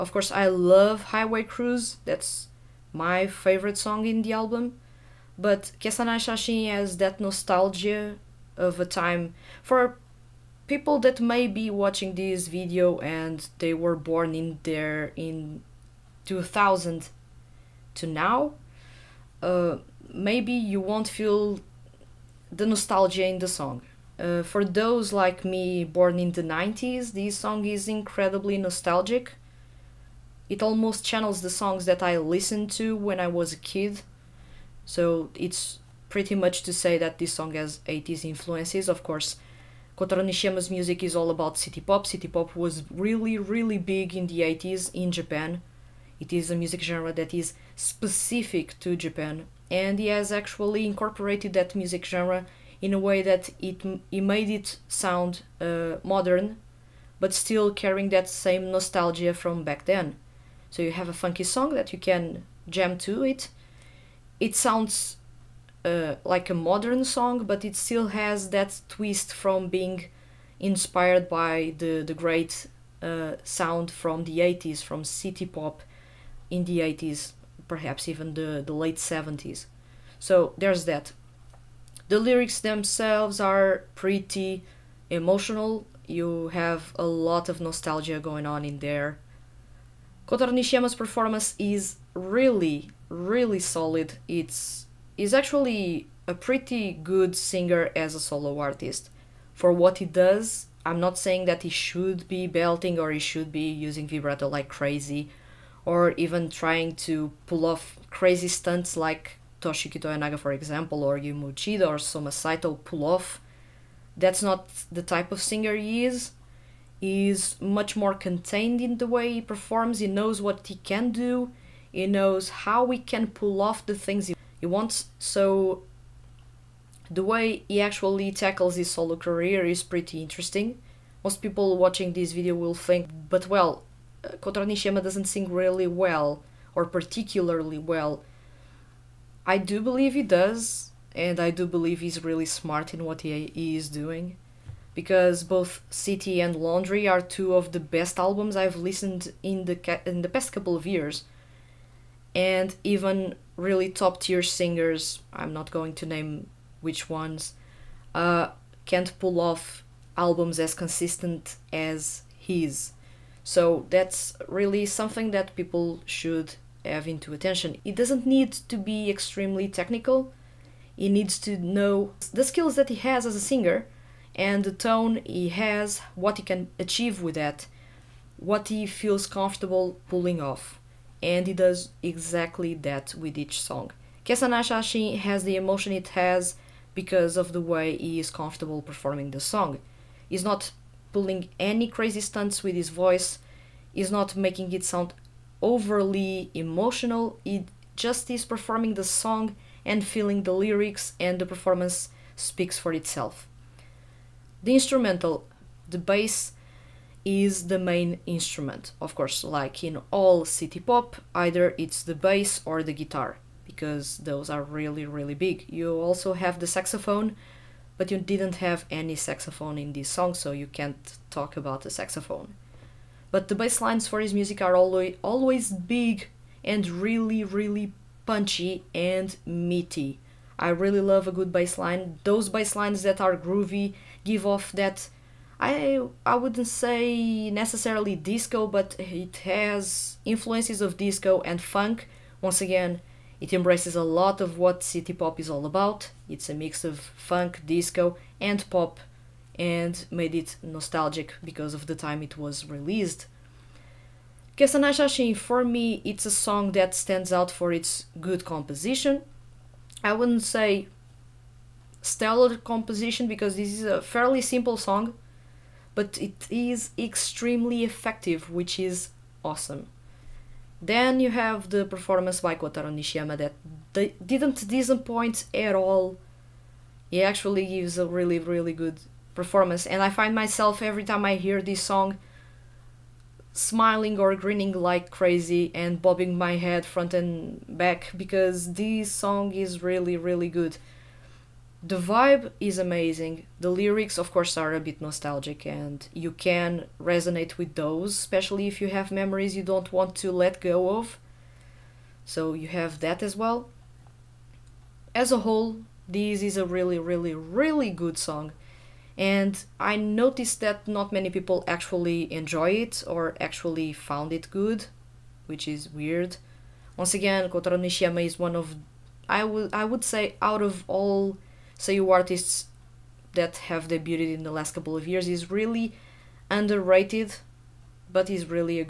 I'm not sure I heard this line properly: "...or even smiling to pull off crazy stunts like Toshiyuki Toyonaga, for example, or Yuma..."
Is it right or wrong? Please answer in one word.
wrong.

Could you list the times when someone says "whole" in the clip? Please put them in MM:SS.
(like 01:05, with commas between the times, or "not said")
05:05.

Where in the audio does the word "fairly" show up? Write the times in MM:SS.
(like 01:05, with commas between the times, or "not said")
04:24.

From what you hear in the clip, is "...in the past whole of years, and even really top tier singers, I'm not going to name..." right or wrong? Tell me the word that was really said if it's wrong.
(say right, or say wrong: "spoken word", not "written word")
wrong: "couple", not "whole".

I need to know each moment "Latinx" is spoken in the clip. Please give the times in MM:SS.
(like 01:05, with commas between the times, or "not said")
not said.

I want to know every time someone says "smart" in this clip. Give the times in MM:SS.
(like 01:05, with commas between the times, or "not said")
02:22.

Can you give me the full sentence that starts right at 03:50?
I really love a good bass line.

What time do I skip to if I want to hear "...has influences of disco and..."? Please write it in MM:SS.
03:59.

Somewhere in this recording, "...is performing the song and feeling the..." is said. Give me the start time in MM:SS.
03:18.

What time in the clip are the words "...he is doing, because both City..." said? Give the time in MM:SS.
02:23.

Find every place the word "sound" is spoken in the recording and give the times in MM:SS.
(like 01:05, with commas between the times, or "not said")
00:54, 01:04, 01:13, 03:14.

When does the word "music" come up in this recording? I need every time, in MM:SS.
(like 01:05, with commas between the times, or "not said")
00:40, 00:46, 00:51, 03:44.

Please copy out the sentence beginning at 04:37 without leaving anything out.
He actually gives a really, really good performance.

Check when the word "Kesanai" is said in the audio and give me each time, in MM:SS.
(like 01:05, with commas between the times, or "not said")
00:05, 03:04, 04:14.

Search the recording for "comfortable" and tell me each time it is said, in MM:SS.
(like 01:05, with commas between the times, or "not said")
02:59, 03:08.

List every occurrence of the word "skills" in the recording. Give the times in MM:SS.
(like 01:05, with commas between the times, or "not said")
02:52.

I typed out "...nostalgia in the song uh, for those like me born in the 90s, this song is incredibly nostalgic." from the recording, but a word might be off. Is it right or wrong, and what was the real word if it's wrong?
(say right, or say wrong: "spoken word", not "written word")
right.